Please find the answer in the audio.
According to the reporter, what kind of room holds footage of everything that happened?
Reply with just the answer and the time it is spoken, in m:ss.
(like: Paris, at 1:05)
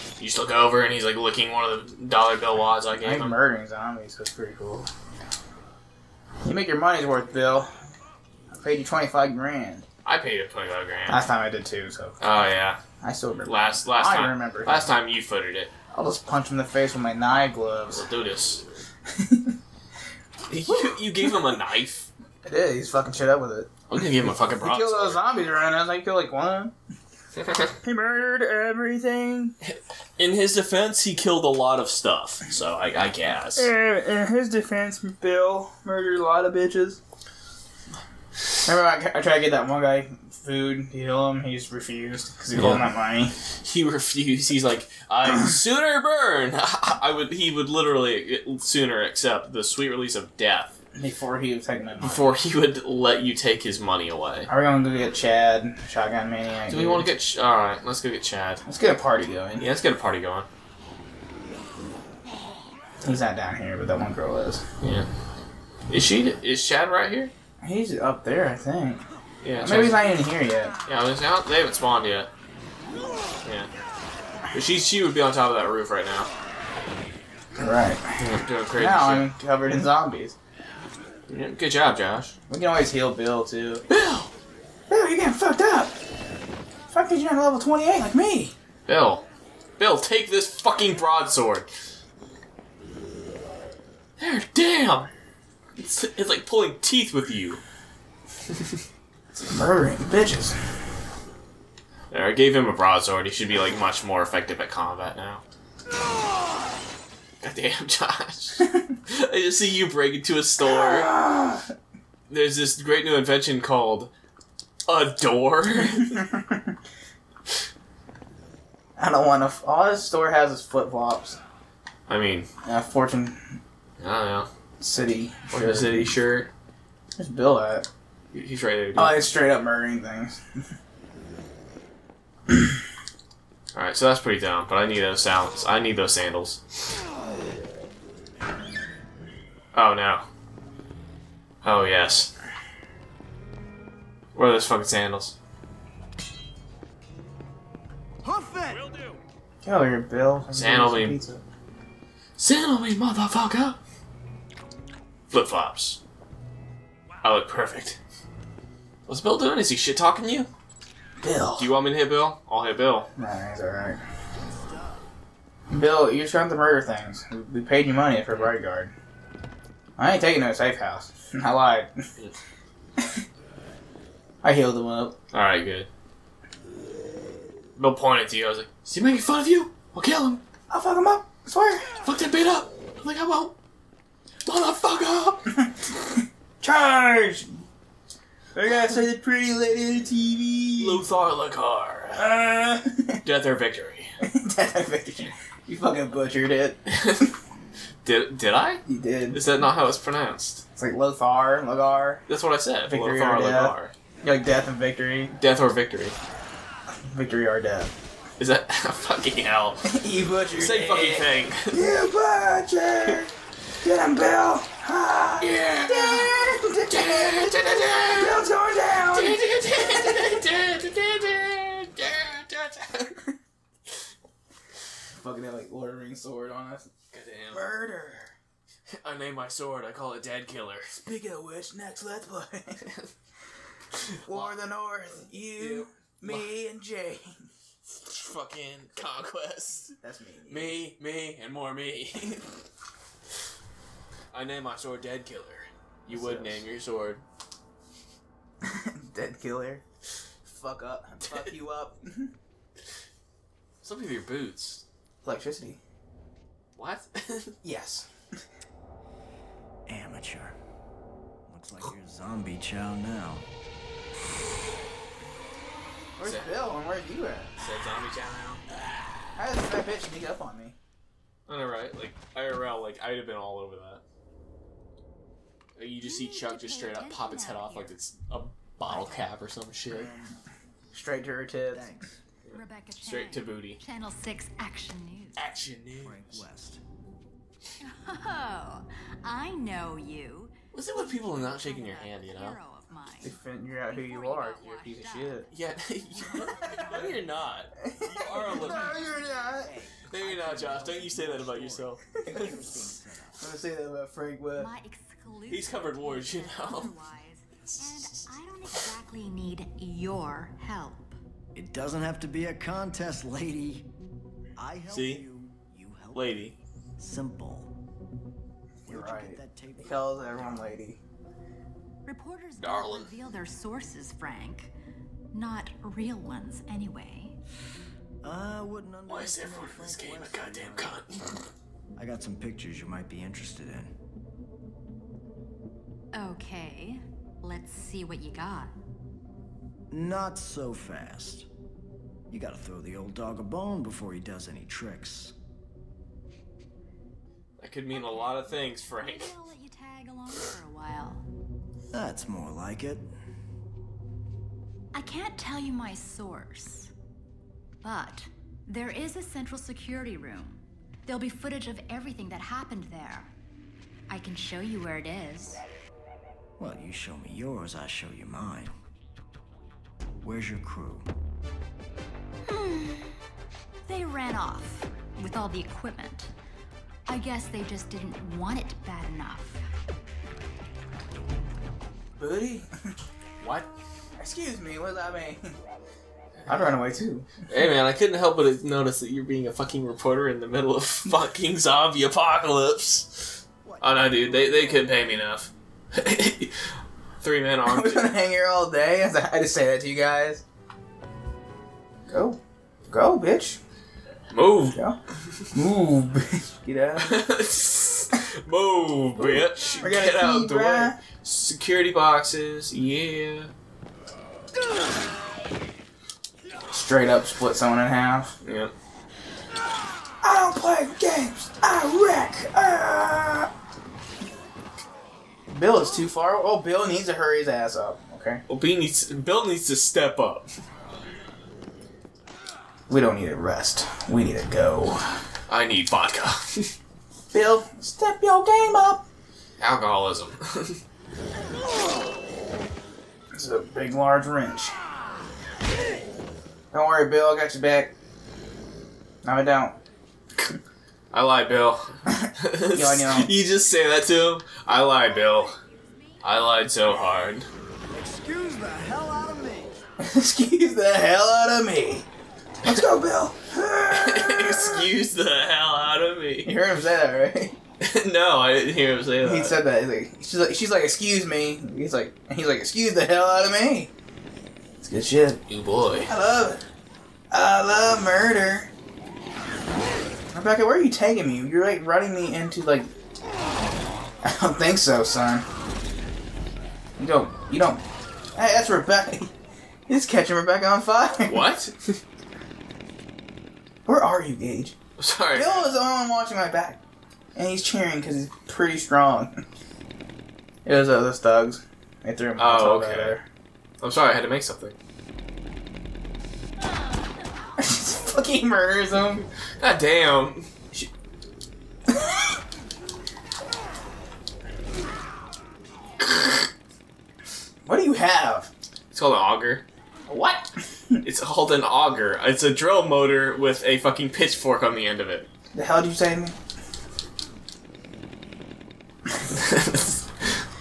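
central security room, at 5:59.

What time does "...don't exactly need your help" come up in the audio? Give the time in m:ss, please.
5:08.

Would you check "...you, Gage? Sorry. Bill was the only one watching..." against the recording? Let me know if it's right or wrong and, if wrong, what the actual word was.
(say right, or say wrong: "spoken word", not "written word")
right.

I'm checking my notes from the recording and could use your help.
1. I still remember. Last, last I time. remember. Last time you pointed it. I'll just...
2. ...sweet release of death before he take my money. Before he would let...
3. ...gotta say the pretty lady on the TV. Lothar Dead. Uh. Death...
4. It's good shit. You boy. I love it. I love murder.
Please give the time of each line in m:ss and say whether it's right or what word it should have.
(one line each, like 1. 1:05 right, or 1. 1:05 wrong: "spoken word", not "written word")
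1. 0:13 wrong: "footed", not "pointed"
2. 0:49 right
3. 3:08 wrong: "Lekar", not "Dead"
4. 7:54 right.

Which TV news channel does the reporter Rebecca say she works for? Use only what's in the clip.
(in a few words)
Channel 6 Action News.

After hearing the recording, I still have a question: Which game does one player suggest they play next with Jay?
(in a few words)
War of the North.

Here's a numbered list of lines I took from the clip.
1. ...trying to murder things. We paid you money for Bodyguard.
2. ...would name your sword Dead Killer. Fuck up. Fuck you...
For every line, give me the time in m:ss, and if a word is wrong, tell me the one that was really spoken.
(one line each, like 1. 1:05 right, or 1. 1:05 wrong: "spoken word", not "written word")
1. 2:46 right
2. 4:06 right.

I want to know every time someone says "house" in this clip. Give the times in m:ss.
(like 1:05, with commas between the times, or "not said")
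2:50.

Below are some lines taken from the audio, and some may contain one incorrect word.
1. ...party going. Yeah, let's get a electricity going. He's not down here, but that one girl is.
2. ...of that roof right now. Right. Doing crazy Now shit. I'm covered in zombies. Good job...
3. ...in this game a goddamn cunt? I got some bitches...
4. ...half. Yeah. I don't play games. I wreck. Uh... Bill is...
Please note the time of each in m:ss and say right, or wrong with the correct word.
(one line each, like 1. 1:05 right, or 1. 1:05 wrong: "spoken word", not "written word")
1. 0:59 wrong: "party", not "electricity"
2. 1:15 right
3. 5:29 wrong: "pictures", not "bitches"
4. 6:57 right.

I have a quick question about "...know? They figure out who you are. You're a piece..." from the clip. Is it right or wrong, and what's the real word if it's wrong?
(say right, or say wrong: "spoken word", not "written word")
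right.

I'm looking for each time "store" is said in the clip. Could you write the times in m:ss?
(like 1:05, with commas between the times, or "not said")
1:50, 2:00.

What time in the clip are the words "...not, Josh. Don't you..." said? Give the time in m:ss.
5:00.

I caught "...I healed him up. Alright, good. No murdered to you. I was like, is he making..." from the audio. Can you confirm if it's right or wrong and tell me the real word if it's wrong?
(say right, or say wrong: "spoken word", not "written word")
wrong: "pointed", not "murdered".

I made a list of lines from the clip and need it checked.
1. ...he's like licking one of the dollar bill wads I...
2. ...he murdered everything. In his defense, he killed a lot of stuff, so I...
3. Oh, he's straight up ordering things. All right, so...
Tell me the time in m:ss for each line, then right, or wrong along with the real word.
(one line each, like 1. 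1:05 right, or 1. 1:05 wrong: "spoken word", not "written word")
1. 0:00 right
2. 0:27 right
3. 2:08 wrong: "murdering", not "ordering".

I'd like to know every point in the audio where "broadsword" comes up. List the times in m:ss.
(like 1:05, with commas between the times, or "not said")
1:30, 1:42.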